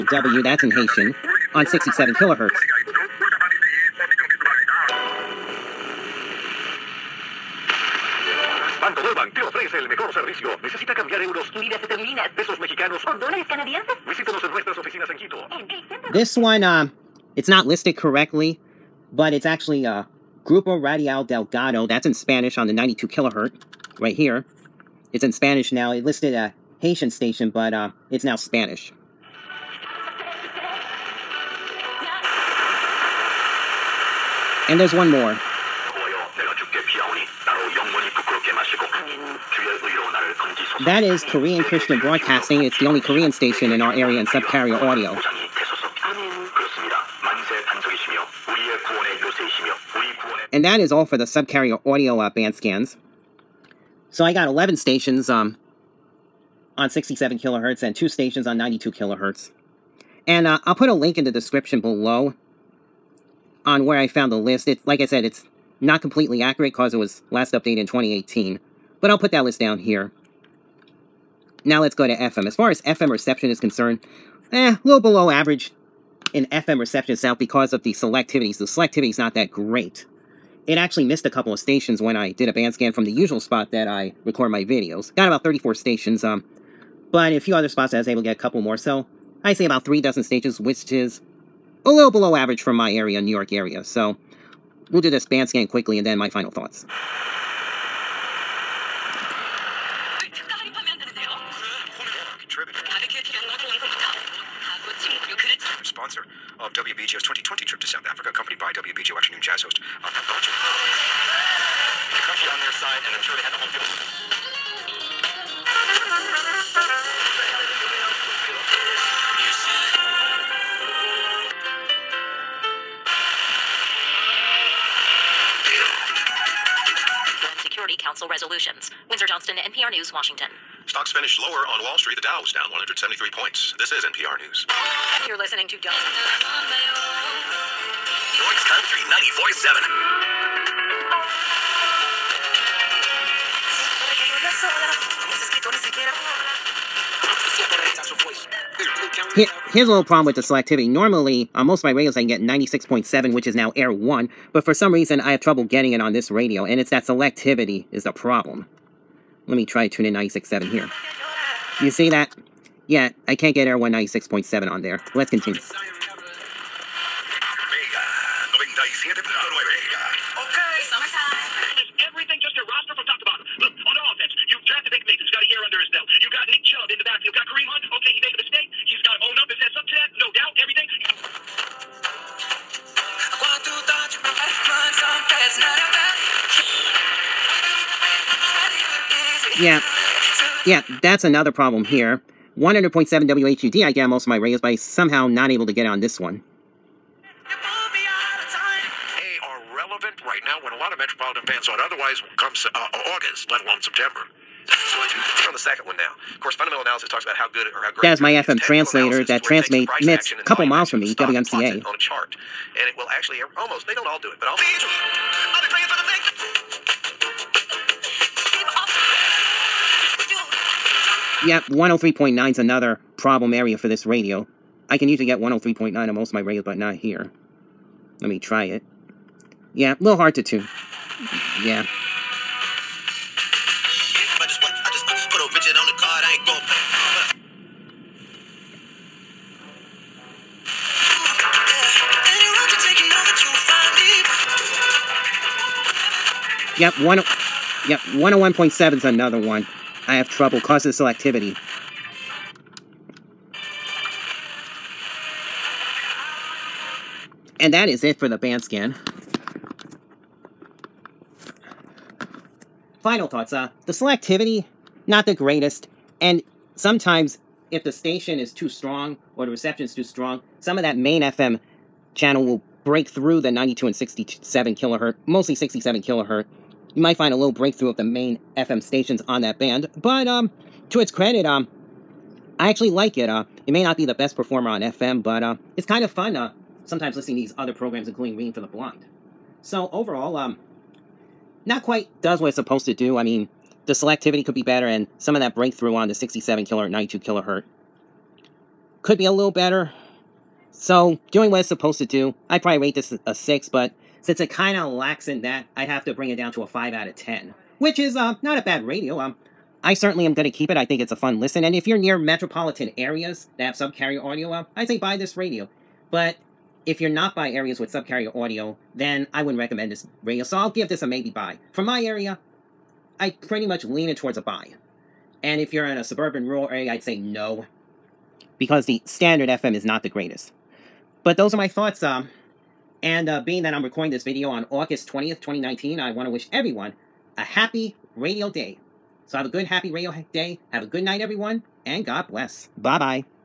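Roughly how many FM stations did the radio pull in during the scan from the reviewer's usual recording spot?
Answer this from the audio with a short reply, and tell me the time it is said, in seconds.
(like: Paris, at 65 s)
34, at 85 s.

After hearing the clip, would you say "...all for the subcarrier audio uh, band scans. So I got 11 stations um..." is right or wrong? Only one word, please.
right.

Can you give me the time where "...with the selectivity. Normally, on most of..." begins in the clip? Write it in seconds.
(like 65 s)
150 s.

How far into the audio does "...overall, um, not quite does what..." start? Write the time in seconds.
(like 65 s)
289 s.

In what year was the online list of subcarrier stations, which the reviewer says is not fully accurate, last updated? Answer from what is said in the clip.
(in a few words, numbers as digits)
2018.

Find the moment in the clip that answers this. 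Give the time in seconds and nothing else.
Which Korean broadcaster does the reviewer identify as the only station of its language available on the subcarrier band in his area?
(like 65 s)
41 s.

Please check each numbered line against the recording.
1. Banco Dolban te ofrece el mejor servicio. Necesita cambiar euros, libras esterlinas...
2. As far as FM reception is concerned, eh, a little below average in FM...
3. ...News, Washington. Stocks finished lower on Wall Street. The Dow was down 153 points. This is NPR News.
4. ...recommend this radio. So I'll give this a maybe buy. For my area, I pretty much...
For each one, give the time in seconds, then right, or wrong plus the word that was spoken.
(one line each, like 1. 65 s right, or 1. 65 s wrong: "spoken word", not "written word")
1. 8 s right
2. 72 s right
3. 129 s wrong: "173", not "153"
4. 319 s right.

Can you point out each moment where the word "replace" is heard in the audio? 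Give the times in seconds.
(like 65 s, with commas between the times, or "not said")
not said.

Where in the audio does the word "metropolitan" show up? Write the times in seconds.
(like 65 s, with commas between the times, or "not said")
200 s, 312 s.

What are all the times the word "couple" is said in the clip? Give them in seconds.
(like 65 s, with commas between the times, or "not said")
81 s, 88 s, 210 s.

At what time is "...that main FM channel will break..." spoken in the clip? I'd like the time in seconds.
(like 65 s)
270 s.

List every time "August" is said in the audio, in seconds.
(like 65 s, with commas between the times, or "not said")
203 s, 334 s.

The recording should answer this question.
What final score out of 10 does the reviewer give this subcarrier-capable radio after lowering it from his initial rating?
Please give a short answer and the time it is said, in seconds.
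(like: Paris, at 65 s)
5, at 306 s.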